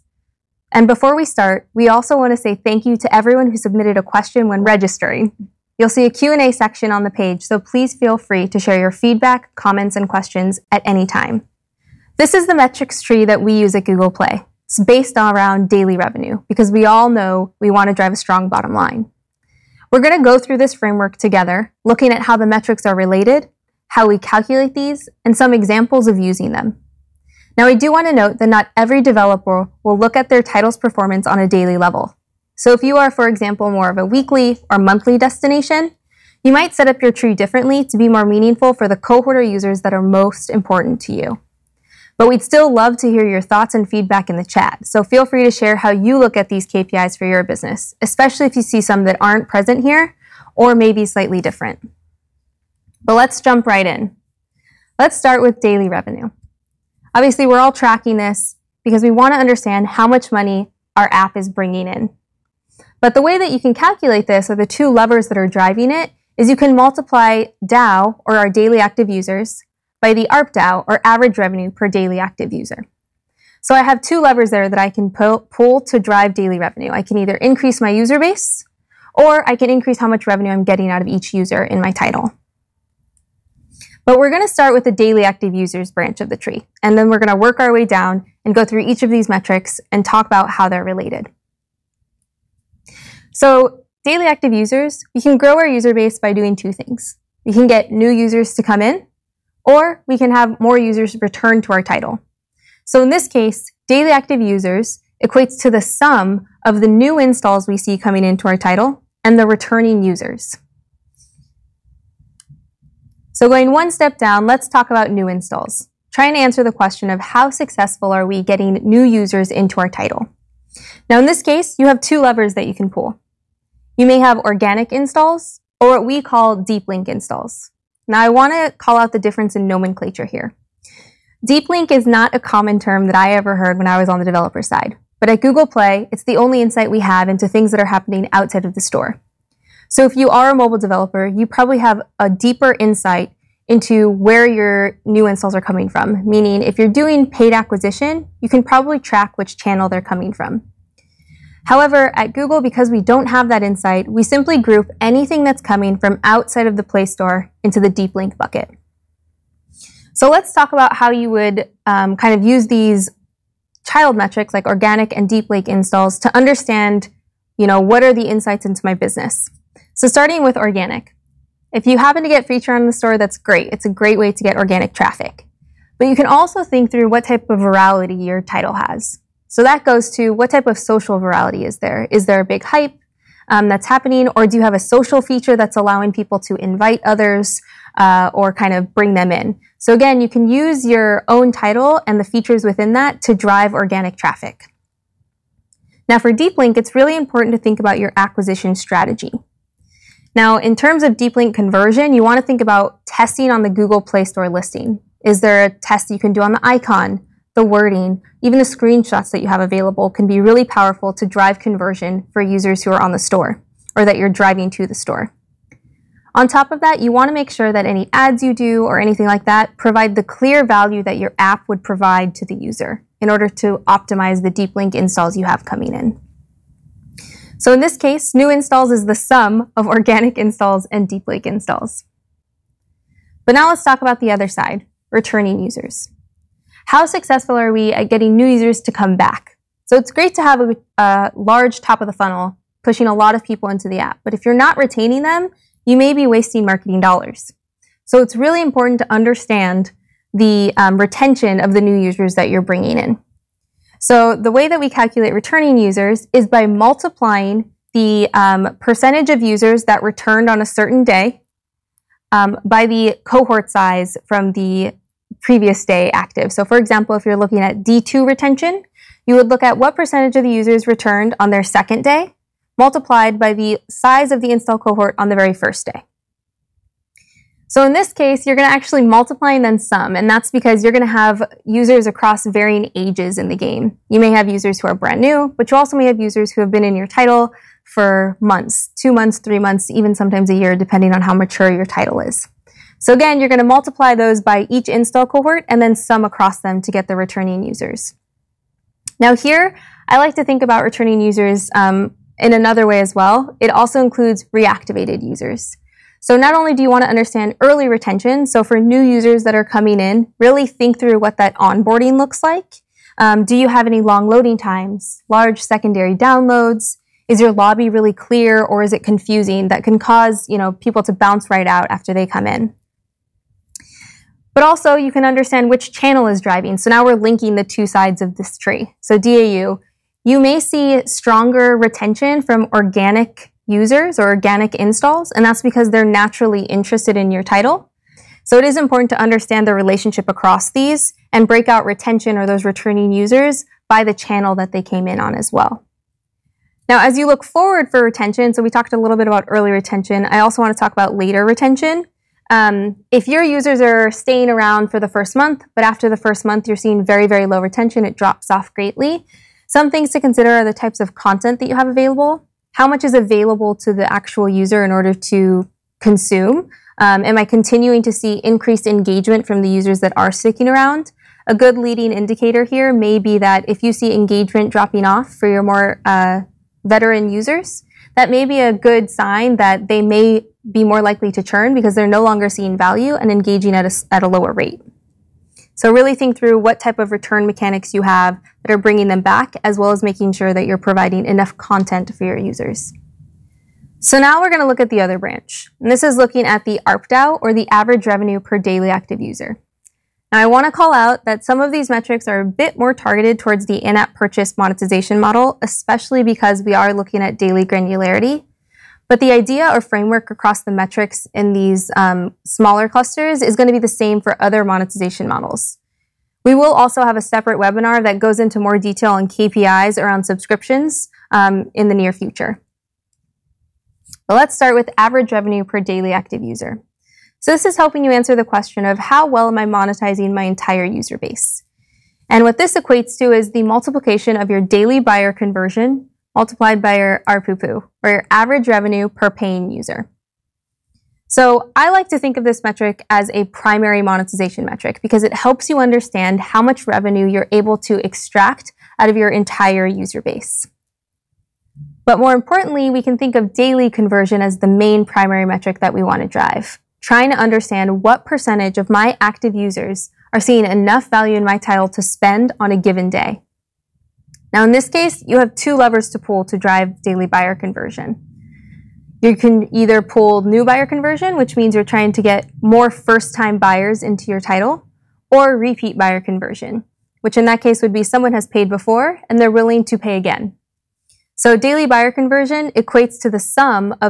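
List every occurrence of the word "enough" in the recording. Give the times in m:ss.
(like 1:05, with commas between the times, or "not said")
6:31, 7:40.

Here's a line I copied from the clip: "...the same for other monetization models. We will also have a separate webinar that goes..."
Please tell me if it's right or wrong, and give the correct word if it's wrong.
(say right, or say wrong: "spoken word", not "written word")
right.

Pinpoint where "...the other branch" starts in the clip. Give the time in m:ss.
6:34.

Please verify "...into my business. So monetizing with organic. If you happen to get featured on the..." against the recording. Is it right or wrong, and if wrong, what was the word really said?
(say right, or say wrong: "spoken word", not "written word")
wrong: "starting", not "monetizing".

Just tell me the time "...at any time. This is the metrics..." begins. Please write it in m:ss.
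0:10.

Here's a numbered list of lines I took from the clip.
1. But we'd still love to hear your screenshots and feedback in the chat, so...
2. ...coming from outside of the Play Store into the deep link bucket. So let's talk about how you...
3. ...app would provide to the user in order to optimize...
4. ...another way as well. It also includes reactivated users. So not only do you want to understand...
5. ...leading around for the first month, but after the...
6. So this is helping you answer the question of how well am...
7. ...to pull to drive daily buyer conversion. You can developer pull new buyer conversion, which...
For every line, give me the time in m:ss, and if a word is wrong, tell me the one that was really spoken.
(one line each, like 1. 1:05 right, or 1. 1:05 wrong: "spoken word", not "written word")
1. 0:42 wrong: "thoughts", not "screenshots"
2. 2:35 right
3. 3:41 right
4. 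5:02 right
5. 5:54 wrong: "staying", not "leading"
6. 7:07 right
7. 7:46 wrong: "either", not "developer".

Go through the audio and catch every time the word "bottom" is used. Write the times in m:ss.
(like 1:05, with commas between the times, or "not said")
0:18.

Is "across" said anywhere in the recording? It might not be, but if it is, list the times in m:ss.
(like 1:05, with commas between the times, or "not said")
4:42, 4:56, 5:40, 6:50.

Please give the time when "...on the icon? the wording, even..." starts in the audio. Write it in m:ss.
3:26.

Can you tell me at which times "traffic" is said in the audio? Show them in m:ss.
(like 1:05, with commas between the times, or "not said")
2:54, 3:14.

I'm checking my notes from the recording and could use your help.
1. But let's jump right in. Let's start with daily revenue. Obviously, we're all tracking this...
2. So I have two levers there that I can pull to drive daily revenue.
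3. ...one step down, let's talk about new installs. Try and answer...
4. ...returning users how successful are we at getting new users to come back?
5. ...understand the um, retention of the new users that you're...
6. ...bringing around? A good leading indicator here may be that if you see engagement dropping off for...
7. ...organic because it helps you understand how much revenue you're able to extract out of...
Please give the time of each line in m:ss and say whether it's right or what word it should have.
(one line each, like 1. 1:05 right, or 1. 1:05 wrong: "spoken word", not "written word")
1. 0:53 right
2. 1:13 right
3. 1:53 right
4. 3:55 right
5. 4:09 right
6. 6:10 wrong: "sticking", not "bringing"
7. 7:24 wrong: "metric", not "organic".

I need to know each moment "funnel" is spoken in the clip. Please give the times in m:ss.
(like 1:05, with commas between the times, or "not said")
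4:02.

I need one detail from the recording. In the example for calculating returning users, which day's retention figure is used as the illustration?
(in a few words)
D2 retention.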